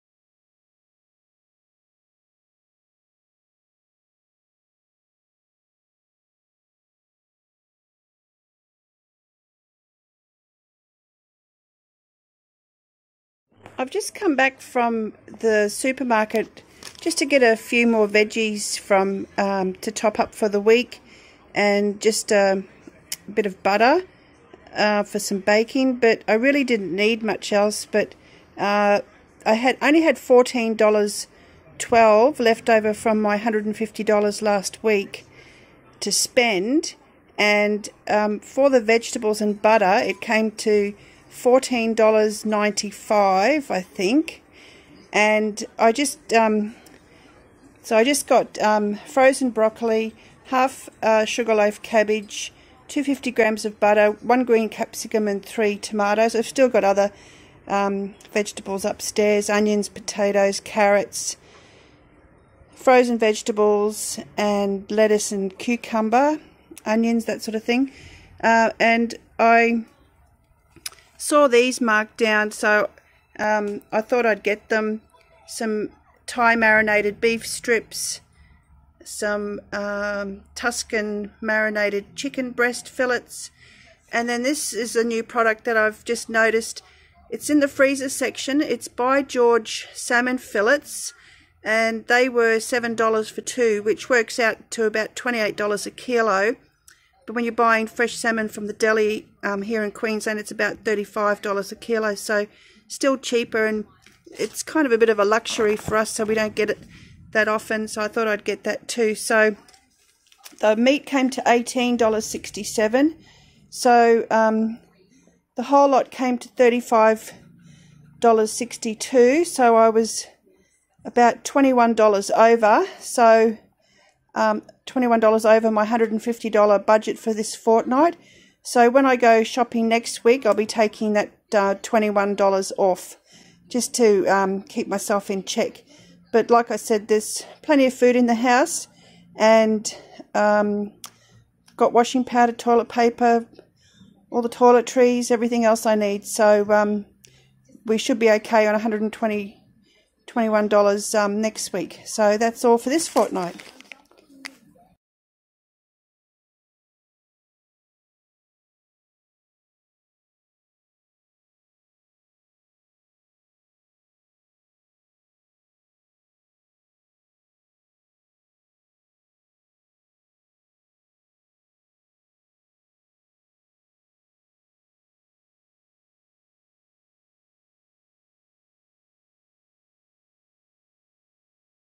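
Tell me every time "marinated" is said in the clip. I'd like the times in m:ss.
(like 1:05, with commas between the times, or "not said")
1:16, 1:21.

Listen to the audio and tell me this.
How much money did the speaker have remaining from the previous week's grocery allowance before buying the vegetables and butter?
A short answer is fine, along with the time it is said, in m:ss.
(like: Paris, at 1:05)
$14.12, at 0:30.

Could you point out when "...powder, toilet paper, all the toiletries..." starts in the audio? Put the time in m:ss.
2:22.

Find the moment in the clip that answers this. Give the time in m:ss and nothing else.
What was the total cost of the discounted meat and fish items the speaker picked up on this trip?
1:51.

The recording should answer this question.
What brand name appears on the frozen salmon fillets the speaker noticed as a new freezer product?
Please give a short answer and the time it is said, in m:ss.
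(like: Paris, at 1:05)
George, at 1:29.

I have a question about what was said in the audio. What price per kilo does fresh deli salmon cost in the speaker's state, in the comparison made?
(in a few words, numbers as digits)
$35 a kilo.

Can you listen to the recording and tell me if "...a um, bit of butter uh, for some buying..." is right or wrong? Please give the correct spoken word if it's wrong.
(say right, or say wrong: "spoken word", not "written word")
wrong: "baking", not "buying".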